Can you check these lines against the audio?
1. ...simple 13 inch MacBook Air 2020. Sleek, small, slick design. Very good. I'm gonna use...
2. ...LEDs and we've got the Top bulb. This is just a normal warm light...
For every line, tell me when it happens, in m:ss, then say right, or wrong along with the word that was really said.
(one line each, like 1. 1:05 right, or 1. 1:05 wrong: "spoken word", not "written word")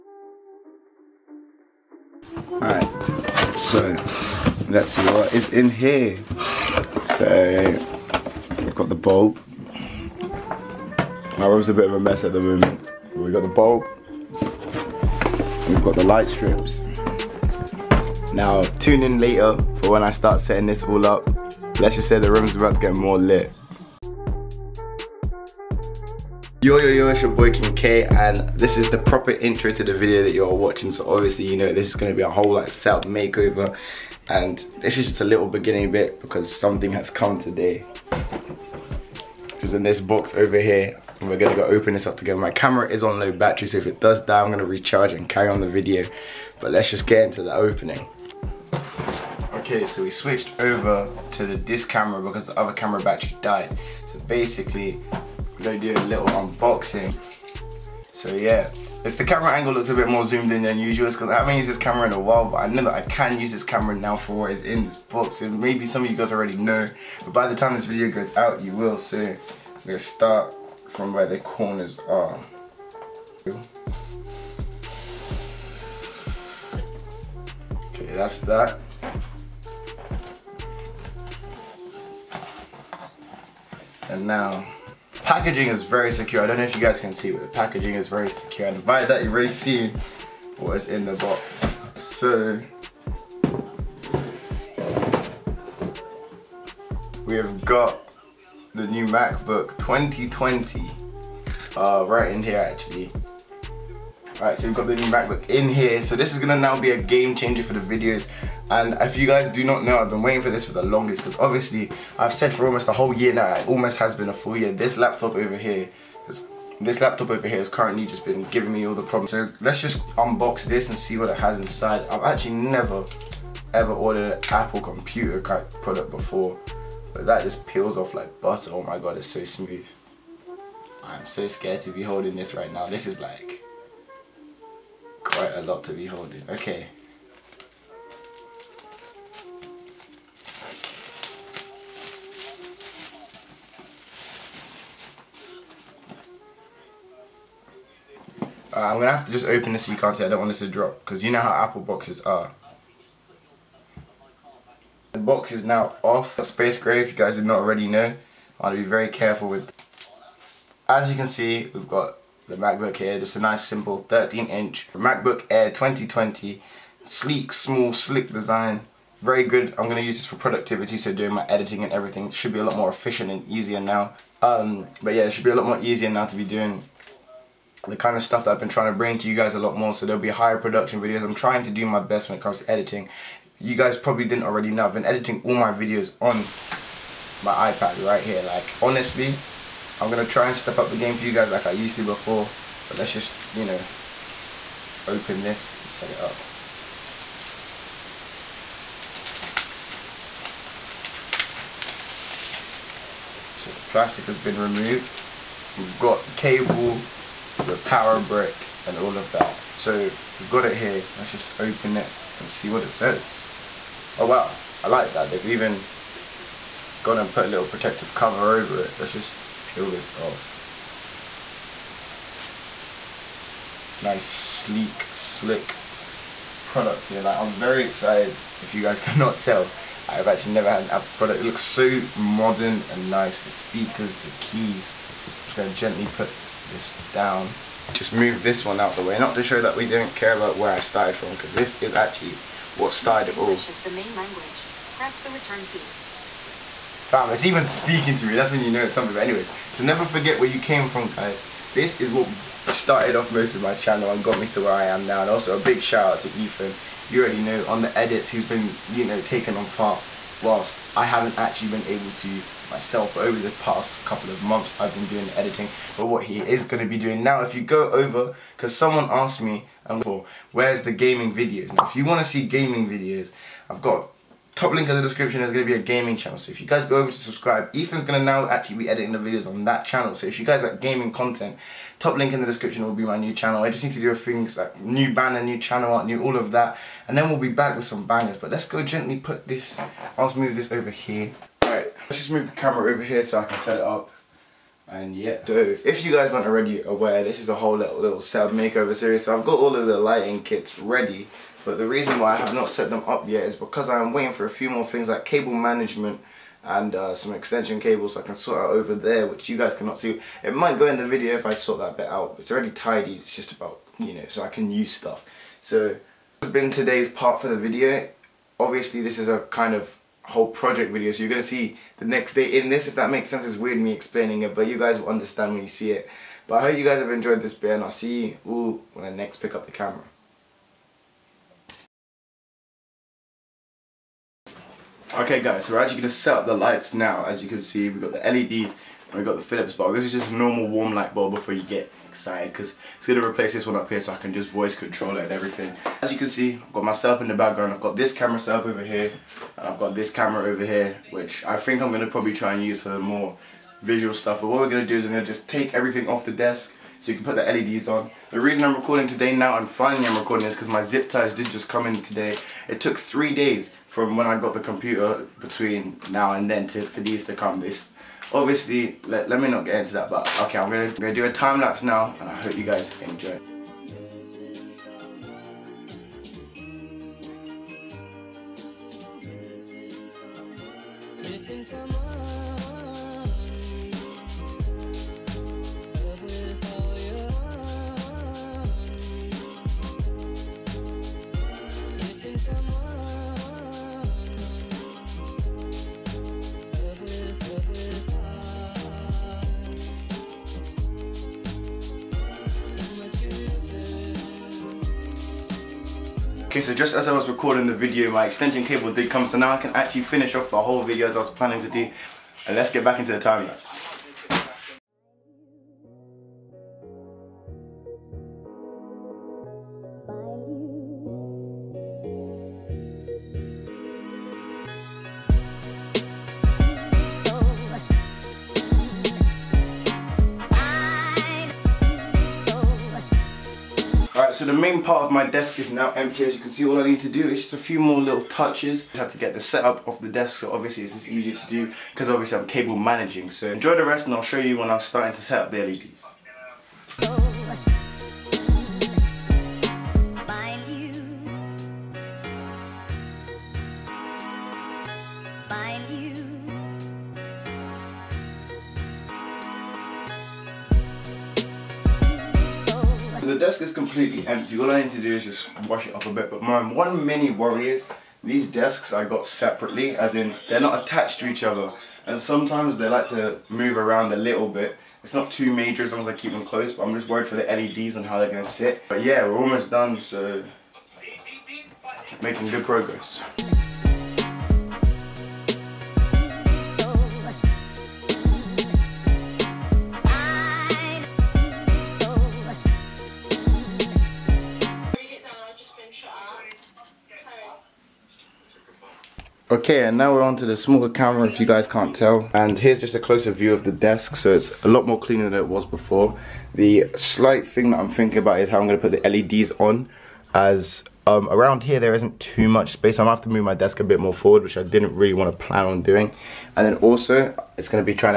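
1. 2:43 right
2. 5:38 wrong: "Philips", not "Top".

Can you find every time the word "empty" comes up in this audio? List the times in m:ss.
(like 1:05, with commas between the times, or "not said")
7:15, 7:44.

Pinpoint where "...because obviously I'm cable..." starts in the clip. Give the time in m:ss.
7:21.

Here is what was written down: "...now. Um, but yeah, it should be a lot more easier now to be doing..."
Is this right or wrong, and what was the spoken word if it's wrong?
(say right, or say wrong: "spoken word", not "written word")
right.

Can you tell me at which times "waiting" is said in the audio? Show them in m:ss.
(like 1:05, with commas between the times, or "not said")
1:50, 5:04.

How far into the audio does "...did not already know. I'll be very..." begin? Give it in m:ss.
2:37.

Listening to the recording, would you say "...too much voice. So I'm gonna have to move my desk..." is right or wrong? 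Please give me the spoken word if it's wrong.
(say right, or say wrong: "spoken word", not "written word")
wrong: "space", not "voice".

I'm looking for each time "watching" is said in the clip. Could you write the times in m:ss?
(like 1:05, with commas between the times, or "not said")
0:30.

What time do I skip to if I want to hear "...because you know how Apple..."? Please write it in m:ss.
2:31.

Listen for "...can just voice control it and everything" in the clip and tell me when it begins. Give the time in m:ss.
5:44.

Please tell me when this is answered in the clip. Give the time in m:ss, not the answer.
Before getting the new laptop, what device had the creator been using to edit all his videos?
3:07.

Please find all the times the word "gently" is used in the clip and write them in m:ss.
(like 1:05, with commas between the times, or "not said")
3:55, 4:48.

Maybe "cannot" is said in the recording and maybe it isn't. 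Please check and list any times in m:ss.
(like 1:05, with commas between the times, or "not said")
3:48, 5:09.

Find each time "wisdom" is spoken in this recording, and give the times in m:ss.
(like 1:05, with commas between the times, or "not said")
not said.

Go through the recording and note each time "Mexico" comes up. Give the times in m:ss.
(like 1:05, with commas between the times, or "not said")
not said.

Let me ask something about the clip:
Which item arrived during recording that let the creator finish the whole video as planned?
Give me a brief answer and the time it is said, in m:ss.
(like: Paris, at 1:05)
Extension cable, at 6:48.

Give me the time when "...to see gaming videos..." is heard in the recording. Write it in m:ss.
4:32.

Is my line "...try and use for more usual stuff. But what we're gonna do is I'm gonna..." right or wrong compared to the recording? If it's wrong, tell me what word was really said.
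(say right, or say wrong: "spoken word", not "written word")
wrong: "visual", not "usual".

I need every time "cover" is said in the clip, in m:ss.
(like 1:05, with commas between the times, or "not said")
3:38.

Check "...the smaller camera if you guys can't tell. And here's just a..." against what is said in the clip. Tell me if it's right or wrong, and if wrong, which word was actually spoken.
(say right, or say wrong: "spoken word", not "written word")
right.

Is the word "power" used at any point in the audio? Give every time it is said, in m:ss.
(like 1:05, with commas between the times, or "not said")
3:27.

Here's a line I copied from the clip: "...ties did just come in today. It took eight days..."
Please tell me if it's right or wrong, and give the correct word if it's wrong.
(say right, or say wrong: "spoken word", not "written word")
wrong: "three", not "eight".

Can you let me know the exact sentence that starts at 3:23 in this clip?
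So the plastic has been removed.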